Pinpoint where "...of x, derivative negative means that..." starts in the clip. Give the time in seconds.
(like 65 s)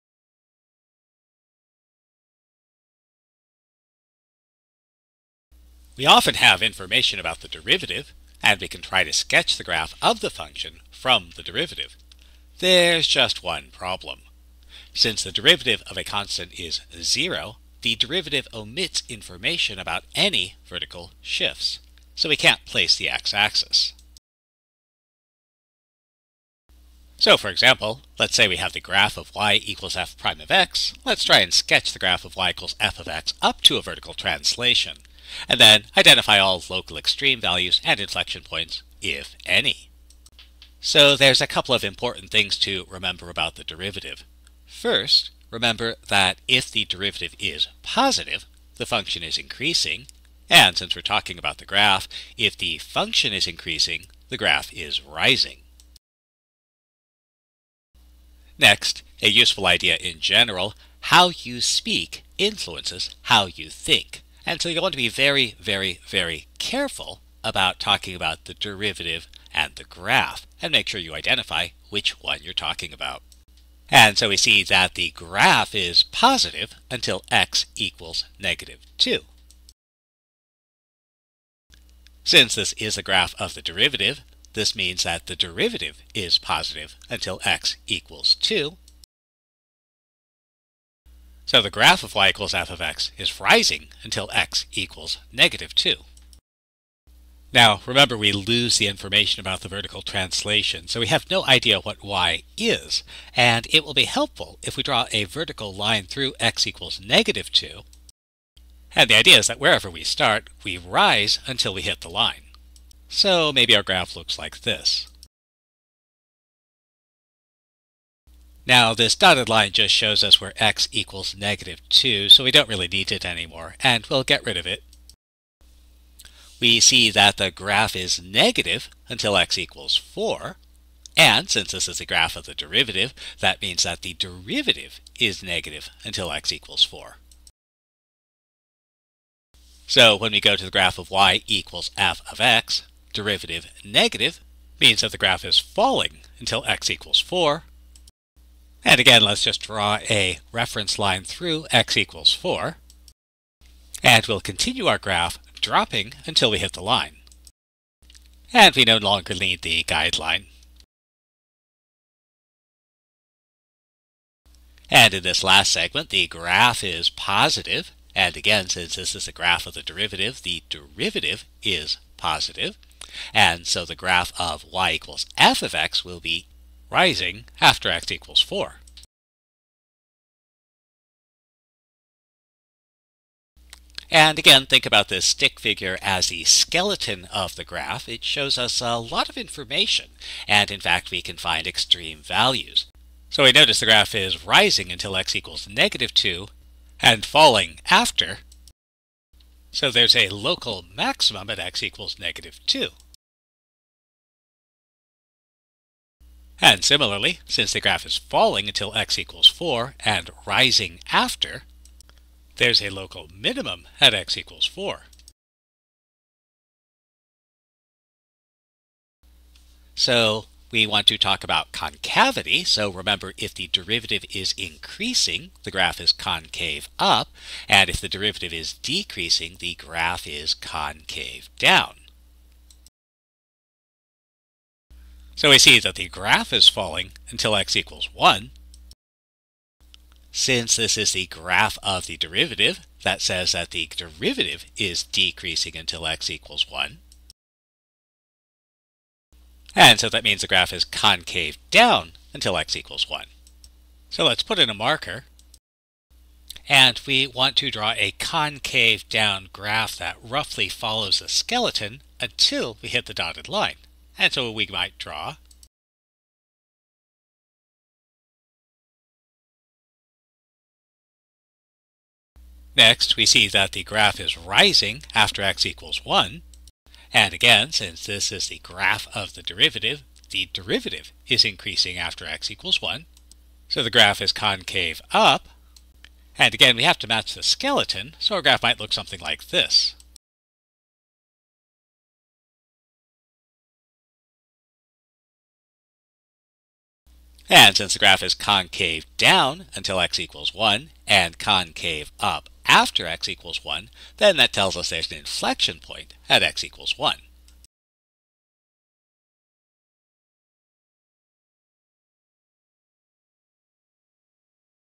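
142 s.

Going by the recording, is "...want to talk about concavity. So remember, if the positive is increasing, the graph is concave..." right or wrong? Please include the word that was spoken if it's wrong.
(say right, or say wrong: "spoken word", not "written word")
wrong: "derivative", not "positive".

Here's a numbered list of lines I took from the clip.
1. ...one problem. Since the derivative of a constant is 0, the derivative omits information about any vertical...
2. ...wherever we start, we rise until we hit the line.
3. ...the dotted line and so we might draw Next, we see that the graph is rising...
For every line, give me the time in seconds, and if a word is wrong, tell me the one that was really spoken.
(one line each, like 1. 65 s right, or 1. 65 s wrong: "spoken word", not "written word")
1. 13 s right
2. 109 s right
3. 263 s right.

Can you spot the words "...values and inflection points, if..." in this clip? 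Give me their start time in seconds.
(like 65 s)
37 s.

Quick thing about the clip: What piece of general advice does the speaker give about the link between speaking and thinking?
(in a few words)
How you speak influences how you think.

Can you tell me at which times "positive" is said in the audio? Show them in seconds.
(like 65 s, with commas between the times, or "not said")
47 s, 76 s, 86 s, 167 s, 172 s.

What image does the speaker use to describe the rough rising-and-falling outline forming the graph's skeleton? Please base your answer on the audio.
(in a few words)
stick figure.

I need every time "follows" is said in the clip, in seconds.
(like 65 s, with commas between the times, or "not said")
260 s.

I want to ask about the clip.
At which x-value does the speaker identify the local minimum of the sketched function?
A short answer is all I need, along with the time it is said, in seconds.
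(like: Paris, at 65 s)
4, at 212 s.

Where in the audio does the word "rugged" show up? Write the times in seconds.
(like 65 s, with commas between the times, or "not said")
not said.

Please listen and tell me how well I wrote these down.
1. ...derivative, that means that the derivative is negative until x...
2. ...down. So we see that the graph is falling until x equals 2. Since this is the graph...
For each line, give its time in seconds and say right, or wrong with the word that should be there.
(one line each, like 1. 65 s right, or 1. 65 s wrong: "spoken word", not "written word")
1. 132 s right
2. 231 s wrong: "1", not "2".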